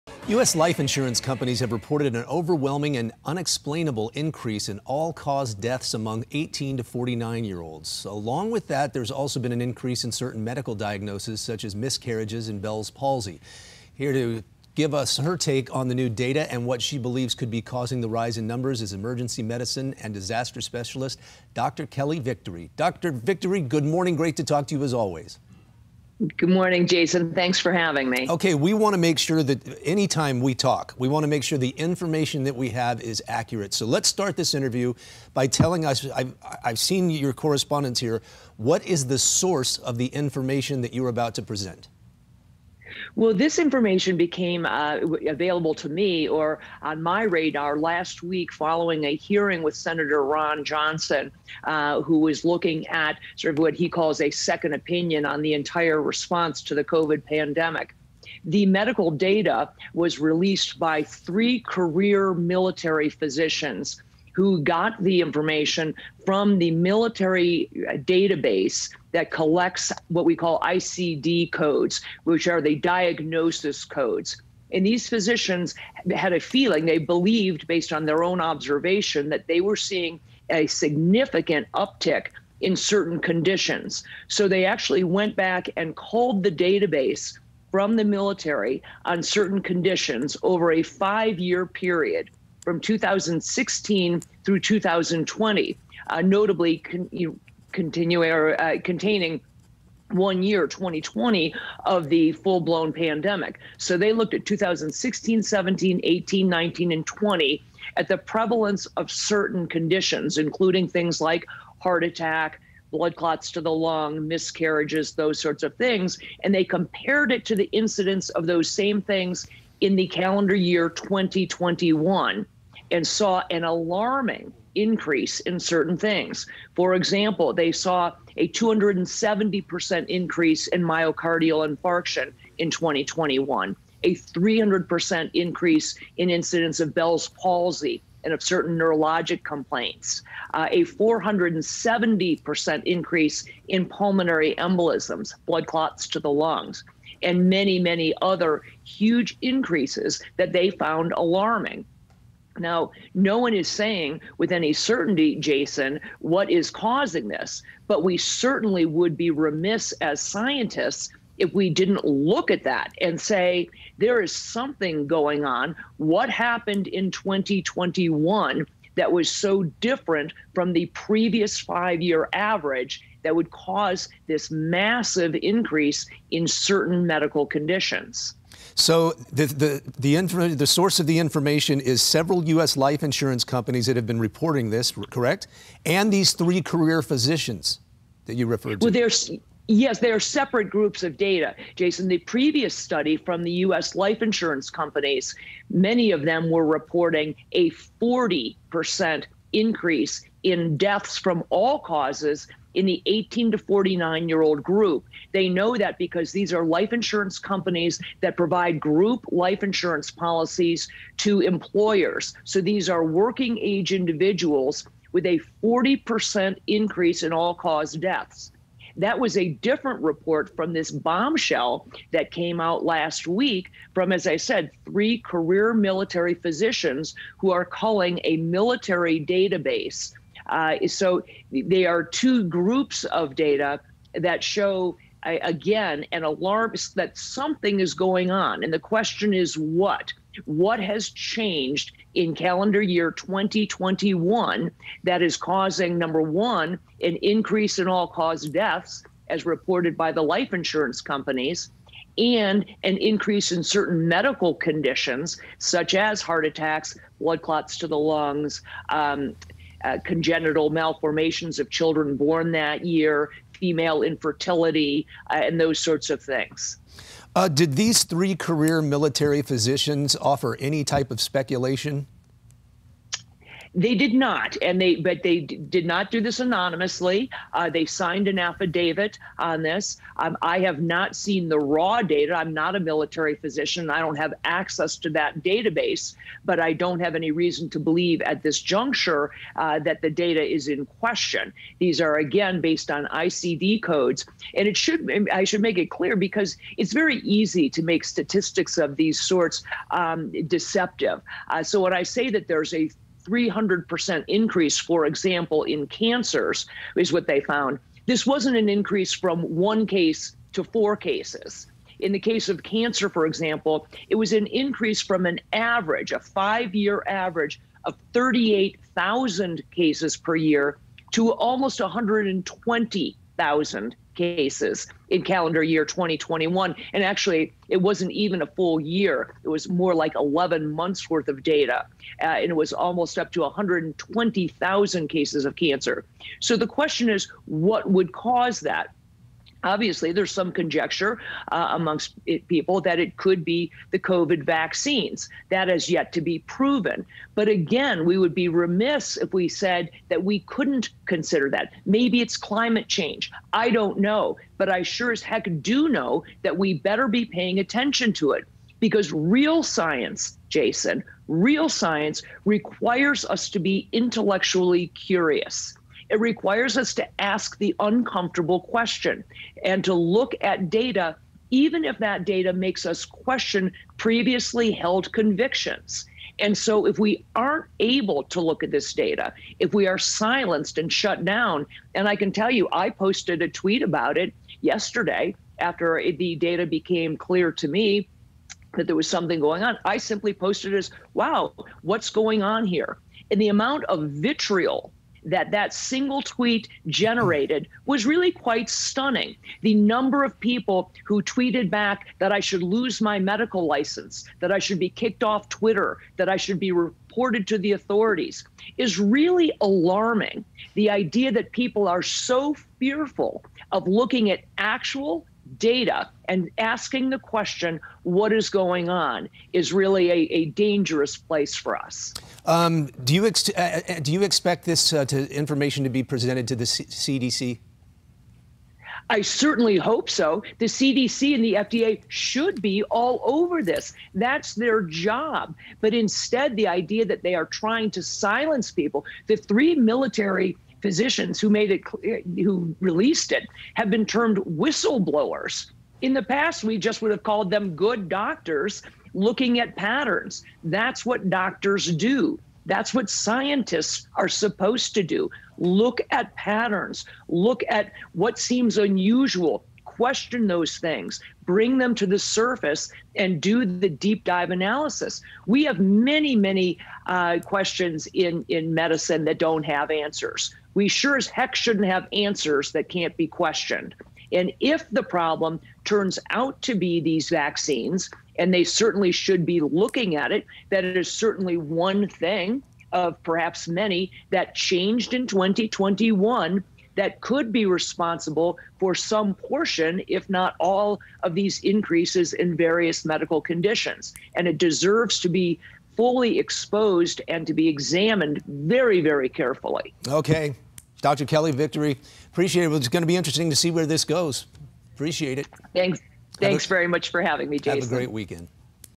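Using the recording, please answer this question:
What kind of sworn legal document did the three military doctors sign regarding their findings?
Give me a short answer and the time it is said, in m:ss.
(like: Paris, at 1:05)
An affidavit, at 4:38.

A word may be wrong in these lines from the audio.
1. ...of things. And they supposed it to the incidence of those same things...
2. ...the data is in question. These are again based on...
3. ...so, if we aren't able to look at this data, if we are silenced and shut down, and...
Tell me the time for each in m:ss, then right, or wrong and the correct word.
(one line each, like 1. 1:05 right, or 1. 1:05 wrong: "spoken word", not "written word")
1. 1:55 wrong: "compared", not "supposed"
2. 4:50 right
3. 6:16 right.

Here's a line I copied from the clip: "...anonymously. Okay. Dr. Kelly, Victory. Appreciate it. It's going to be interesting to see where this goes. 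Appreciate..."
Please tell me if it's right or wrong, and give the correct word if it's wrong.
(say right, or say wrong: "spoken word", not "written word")
wrong: "carefully", not "anonymously".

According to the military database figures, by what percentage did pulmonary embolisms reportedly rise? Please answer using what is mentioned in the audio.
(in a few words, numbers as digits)
470%.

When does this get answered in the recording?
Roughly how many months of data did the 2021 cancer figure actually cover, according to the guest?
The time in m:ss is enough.
5:30.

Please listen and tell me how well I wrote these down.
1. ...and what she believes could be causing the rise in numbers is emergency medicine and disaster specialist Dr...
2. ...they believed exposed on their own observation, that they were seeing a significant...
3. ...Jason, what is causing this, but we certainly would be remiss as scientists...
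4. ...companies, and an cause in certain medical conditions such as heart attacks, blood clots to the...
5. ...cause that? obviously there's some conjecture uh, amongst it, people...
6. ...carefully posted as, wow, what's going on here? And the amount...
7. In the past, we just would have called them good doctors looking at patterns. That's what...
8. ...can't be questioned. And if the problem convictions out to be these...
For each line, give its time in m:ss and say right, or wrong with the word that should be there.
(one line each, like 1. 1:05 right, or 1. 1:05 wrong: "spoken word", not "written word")
1. 0:16 right
2. 1:16 wrong: "based", not "exposed"
3. 2:35 right
4. 4:11 wrong: "increase", not "cause"
5. 5:38 right
6. 6:29 wrong: "simply", not "carefully"
7. 7:26 right
8. 7:52 wrong: "turns", not "convictions".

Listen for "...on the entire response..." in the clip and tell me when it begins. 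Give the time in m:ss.
0:55.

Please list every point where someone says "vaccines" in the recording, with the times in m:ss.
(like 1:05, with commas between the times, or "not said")
5:44, 7:57.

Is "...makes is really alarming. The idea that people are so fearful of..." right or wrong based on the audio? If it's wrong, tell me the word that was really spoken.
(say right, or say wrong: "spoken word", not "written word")
wrong: "authorities", not "makes".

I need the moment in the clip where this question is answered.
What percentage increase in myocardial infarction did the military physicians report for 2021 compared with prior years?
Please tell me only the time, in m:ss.
2:08.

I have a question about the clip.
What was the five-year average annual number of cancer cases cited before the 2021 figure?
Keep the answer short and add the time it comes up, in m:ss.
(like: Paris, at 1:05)
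38,000, at 5:18.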